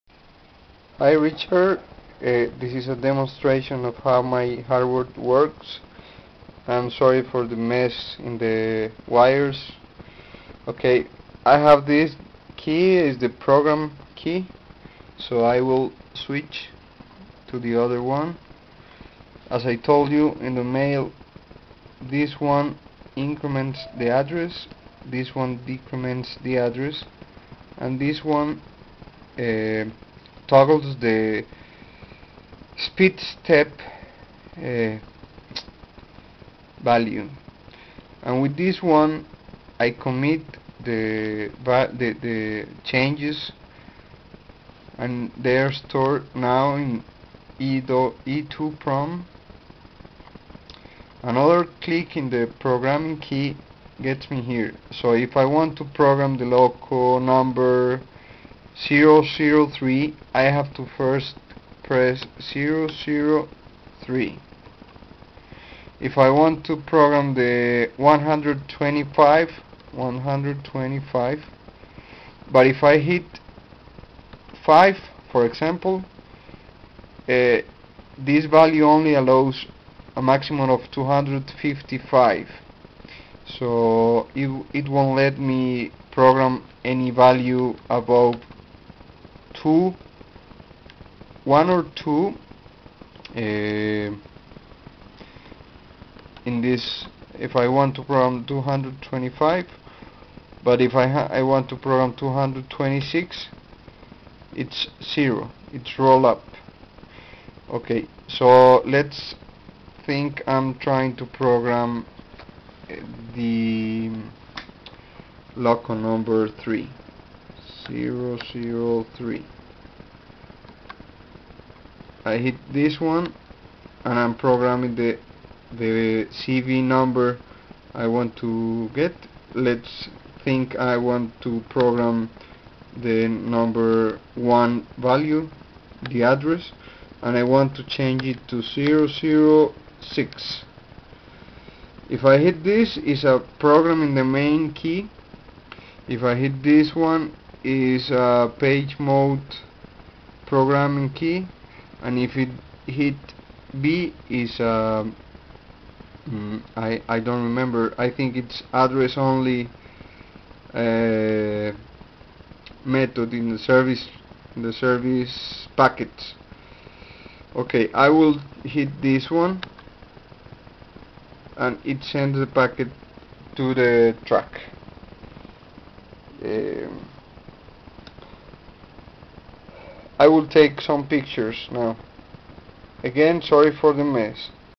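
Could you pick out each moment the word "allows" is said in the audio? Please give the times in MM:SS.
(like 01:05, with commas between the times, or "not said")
01:19.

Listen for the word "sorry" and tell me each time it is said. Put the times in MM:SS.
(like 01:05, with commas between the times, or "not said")
00:06, 03:03.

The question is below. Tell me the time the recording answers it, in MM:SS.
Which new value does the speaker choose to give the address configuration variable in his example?
02:18.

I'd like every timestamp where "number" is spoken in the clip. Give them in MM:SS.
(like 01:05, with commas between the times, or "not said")
00:57, 01:55, 02:06, 02:13.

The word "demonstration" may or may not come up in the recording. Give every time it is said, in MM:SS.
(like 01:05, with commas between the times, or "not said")
00:02.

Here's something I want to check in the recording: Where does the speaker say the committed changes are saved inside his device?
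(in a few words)
E2 prom.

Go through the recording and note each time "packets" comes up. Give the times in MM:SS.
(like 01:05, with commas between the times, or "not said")
02:45, 02:52.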